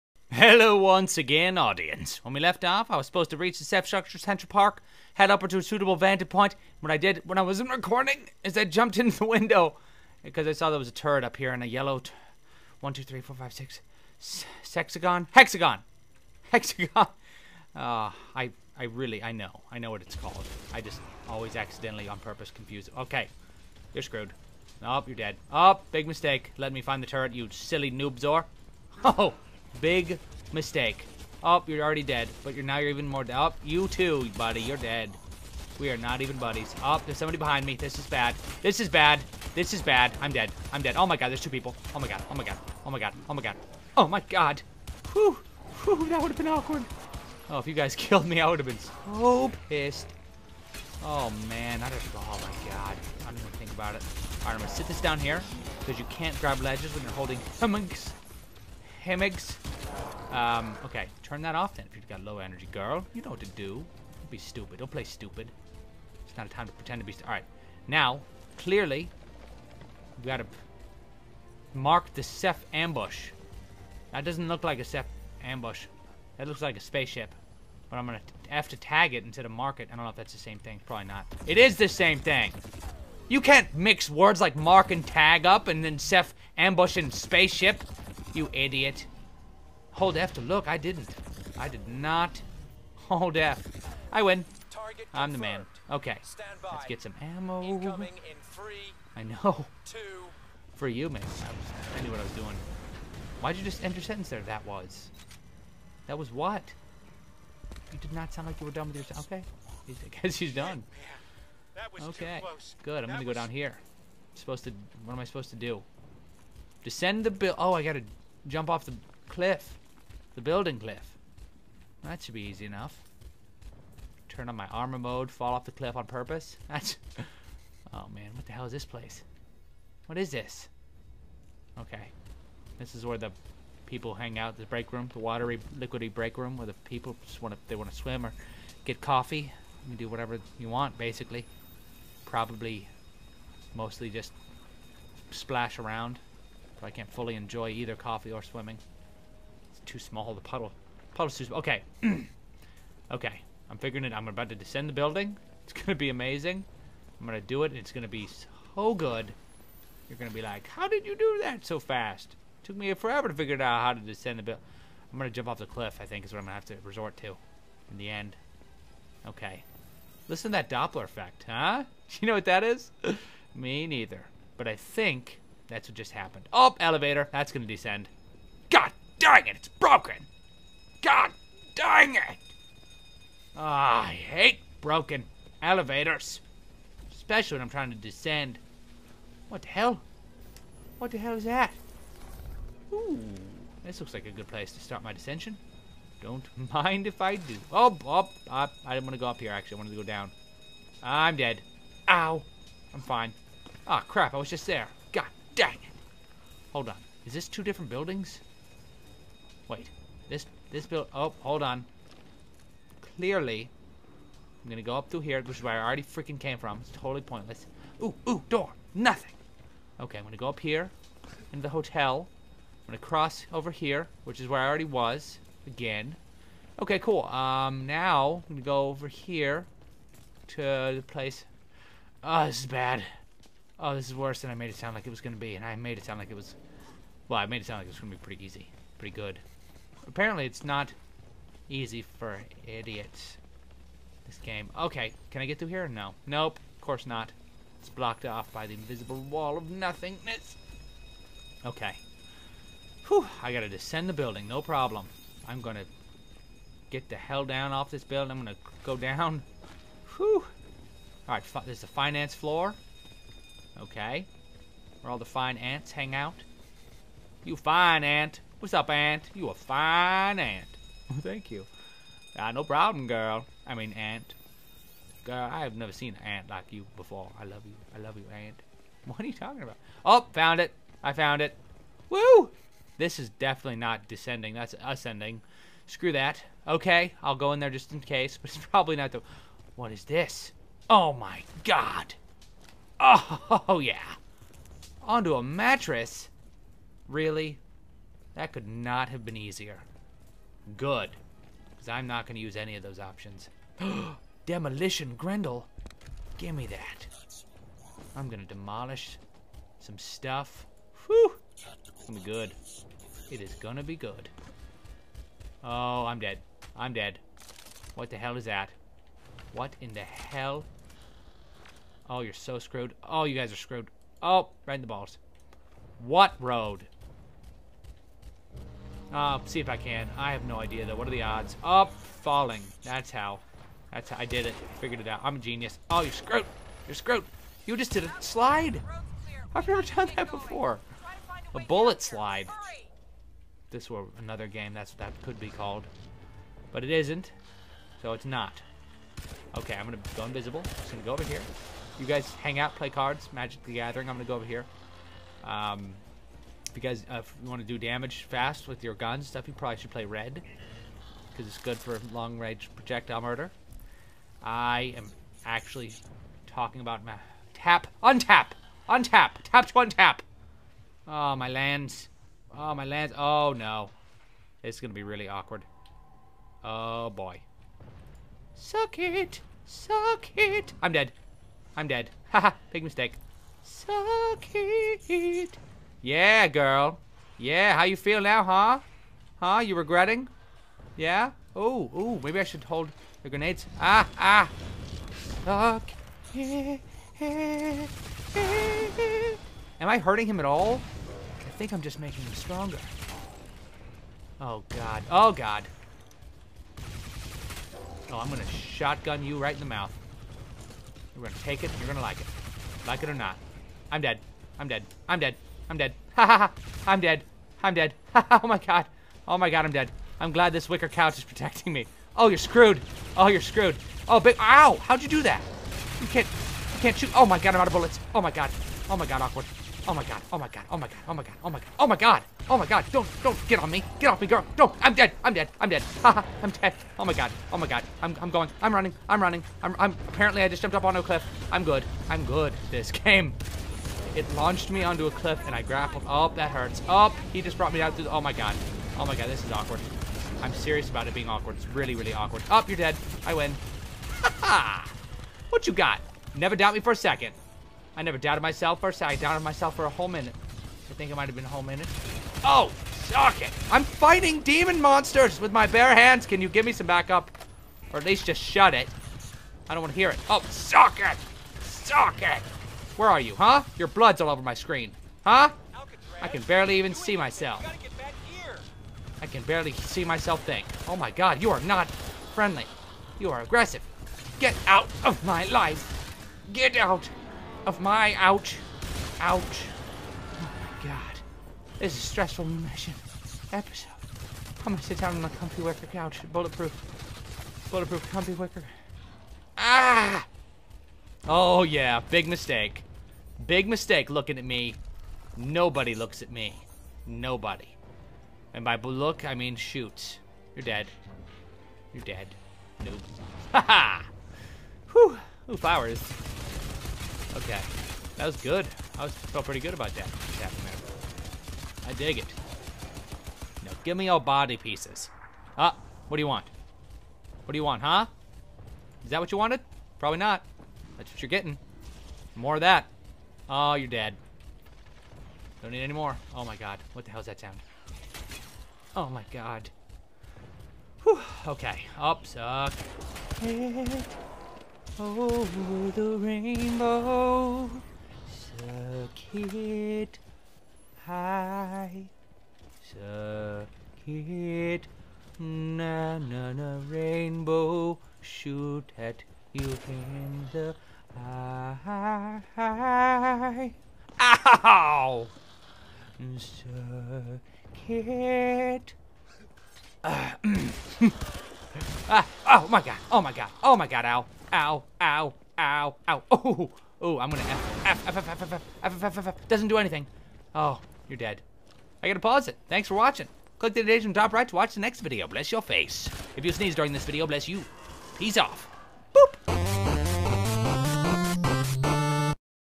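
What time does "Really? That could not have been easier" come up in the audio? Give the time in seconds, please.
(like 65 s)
297 s.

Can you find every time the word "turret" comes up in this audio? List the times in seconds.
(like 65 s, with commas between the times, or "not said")
10 s, 27 s.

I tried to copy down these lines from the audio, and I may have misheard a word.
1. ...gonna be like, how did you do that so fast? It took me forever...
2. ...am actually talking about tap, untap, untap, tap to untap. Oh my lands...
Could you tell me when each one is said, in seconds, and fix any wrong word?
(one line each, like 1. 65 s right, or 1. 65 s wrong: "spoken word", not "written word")
1. 160 s right
2. 364 s right.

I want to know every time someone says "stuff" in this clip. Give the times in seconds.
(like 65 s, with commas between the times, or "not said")
309 s, 359 s.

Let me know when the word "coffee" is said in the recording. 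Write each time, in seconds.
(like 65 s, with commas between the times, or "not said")
139 s, 147 s.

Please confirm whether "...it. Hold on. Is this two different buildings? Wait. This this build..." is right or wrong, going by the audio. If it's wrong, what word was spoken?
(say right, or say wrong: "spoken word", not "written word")
right.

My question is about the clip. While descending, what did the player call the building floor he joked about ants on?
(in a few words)
finance floor.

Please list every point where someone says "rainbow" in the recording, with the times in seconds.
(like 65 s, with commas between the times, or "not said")
546 s, 556 s.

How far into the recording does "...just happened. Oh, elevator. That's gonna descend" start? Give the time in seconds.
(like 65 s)
175 s.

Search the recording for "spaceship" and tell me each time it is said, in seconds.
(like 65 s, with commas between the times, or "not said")
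76 s, 87 s.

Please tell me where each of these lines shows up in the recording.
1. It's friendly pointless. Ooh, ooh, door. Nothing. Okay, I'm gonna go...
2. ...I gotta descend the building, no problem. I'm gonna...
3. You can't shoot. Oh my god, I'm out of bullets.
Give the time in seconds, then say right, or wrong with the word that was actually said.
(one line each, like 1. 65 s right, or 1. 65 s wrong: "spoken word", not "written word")
1. 216 s wrong: "totally", not "friendly"
2. 253 s right
3. 426 s right.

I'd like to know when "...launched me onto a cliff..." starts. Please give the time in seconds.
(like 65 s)
444 s.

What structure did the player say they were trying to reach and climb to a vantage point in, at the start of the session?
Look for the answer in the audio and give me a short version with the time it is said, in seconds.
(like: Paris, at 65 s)
Ceph Structure Central Park, at 3 s.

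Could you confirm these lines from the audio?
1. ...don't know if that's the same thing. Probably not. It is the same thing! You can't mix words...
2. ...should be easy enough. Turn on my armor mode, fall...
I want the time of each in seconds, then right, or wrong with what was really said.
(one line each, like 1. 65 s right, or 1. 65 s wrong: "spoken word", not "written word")
1. 79 s right
2. 122 s right.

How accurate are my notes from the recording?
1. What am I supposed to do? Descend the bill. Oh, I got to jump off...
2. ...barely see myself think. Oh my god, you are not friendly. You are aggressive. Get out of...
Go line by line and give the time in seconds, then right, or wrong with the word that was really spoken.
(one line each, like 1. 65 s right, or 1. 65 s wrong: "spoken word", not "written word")
1. 115 s right
2. 479 s right.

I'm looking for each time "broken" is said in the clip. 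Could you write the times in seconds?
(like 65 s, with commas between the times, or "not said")
179 s, 184 s.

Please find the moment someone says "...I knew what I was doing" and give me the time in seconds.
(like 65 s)
101 s.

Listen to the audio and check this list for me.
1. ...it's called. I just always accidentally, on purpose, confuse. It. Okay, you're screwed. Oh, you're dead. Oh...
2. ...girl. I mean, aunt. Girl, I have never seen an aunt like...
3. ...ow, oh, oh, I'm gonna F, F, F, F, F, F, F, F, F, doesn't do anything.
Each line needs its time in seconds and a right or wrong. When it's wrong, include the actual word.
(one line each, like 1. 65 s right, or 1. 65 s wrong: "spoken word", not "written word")
1. 20 s right
2. 273 s right
3. 576 s right.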